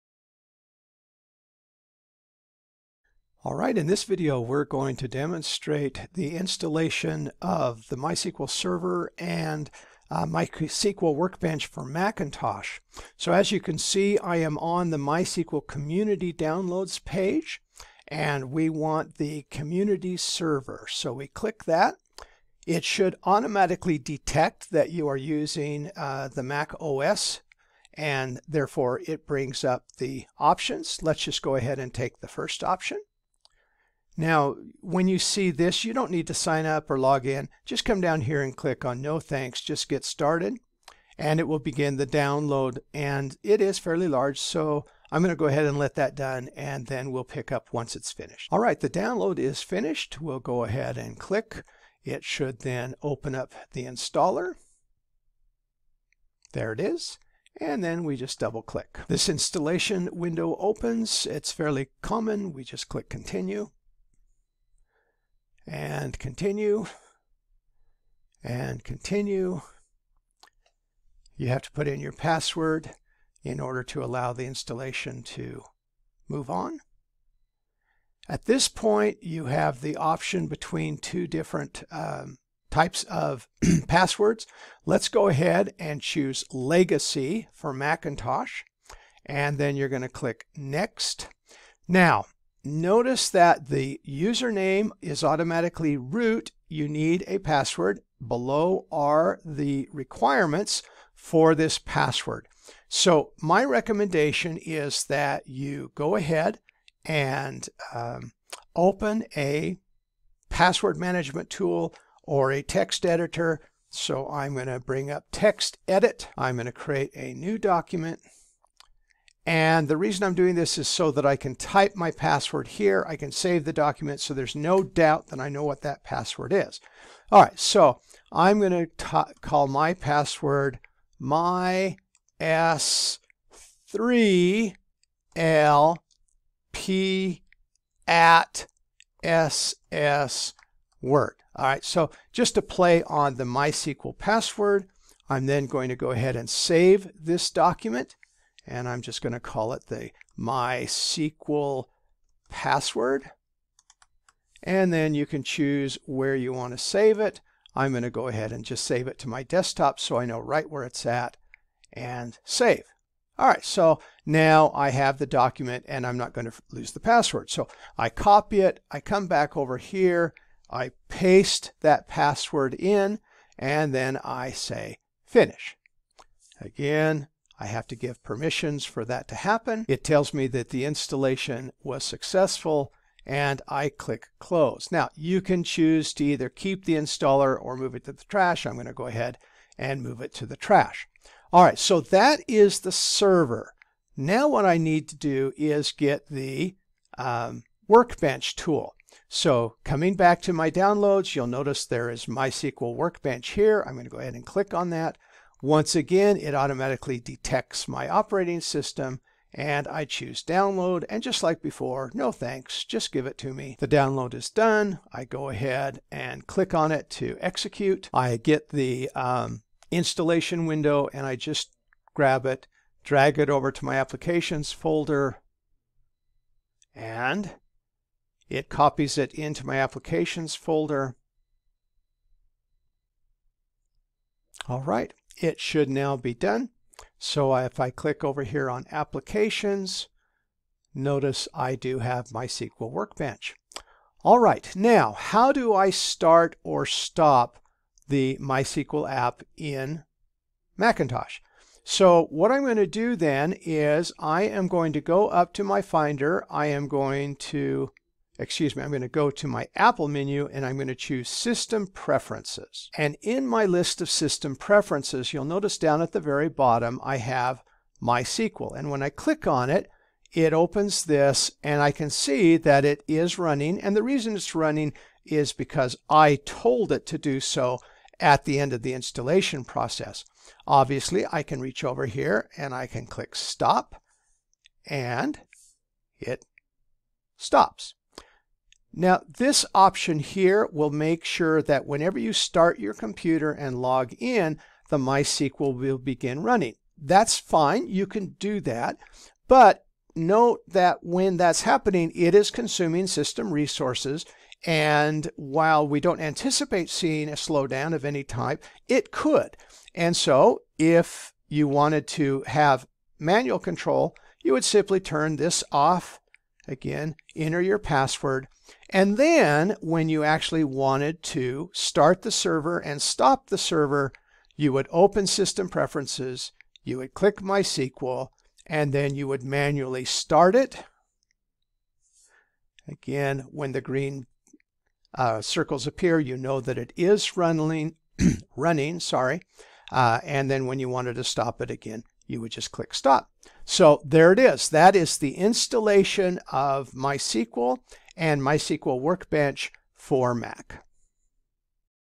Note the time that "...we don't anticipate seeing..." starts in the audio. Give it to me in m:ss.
5:05.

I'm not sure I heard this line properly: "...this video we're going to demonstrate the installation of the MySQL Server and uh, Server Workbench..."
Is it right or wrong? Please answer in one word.
wrong.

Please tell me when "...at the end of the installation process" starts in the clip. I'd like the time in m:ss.
4:38.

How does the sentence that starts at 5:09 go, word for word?
And so if you wanted to have manual control, you would simply turn this off Again, enter your password.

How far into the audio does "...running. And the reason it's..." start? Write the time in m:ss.
4:33.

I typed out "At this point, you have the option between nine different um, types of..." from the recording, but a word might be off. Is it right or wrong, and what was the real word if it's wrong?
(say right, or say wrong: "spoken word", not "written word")
wrong: "two", not "nine".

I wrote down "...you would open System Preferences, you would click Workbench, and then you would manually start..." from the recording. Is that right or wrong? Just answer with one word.
wrong.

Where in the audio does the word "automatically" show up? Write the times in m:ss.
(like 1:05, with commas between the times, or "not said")
0:23, 1:35, 3:26.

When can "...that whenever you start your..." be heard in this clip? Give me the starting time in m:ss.
4:51.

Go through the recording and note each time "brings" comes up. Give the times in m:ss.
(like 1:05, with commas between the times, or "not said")
0:29, 1:54.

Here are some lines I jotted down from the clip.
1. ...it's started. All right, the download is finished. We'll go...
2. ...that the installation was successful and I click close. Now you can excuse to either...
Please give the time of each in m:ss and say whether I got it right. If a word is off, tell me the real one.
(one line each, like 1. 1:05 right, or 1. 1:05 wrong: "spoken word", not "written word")
1. 0:47 wrong: "finished", not "started"
2. 3:00 wrong: "choose", not "excuse".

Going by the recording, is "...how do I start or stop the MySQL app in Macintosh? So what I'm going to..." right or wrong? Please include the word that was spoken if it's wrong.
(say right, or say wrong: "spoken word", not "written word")
right.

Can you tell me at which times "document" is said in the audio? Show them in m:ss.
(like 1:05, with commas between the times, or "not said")
1:57, 2:03, 2:27, 2:45.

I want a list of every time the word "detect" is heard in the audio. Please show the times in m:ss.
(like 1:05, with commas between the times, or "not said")
0:23, 3:27.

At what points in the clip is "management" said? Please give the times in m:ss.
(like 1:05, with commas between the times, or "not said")
1:50.